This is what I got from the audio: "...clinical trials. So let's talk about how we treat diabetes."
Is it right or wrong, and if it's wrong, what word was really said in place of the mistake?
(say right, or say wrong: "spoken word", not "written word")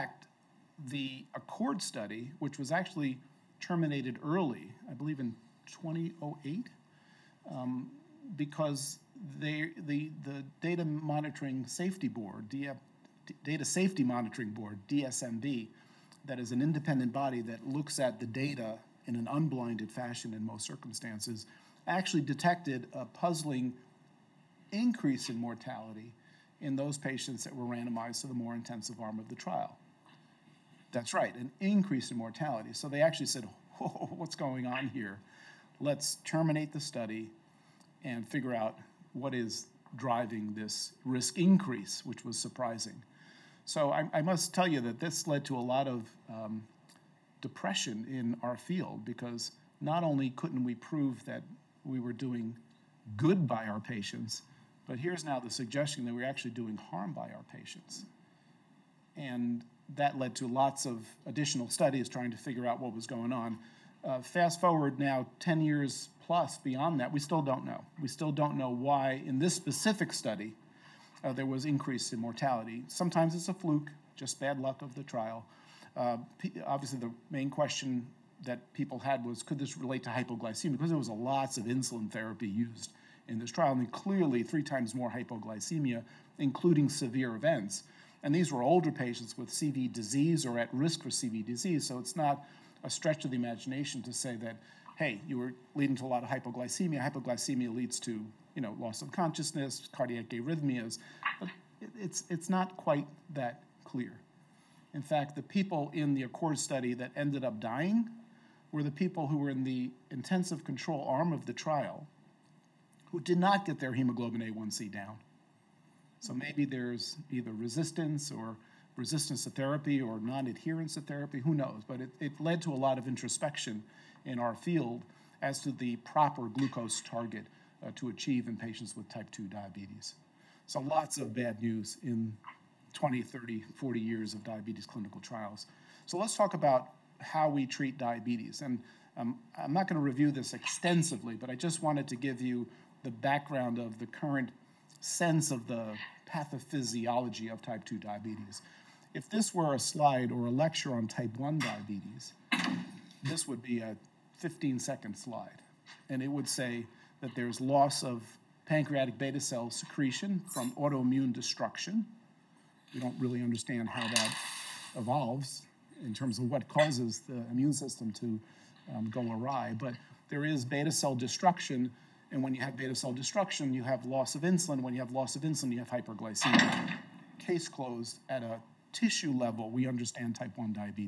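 right.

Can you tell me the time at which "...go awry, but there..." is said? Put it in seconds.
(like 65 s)
169 s.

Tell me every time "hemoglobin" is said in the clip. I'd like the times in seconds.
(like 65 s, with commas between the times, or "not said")
113 s.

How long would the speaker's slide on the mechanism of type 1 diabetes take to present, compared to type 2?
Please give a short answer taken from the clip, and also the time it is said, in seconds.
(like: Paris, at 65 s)
15 seconds, at 154 s.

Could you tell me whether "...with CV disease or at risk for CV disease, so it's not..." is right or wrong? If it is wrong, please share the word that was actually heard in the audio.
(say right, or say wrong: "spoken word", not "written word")
right.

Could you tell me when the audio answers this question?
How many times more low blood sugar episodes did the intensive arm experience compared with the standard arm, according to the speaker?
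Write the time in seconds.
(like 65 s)
84 s.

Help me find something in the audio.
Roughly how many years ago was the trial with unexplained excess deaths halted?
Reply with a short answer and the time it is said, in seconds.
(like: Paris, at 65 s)
10 years plus, at 65 s.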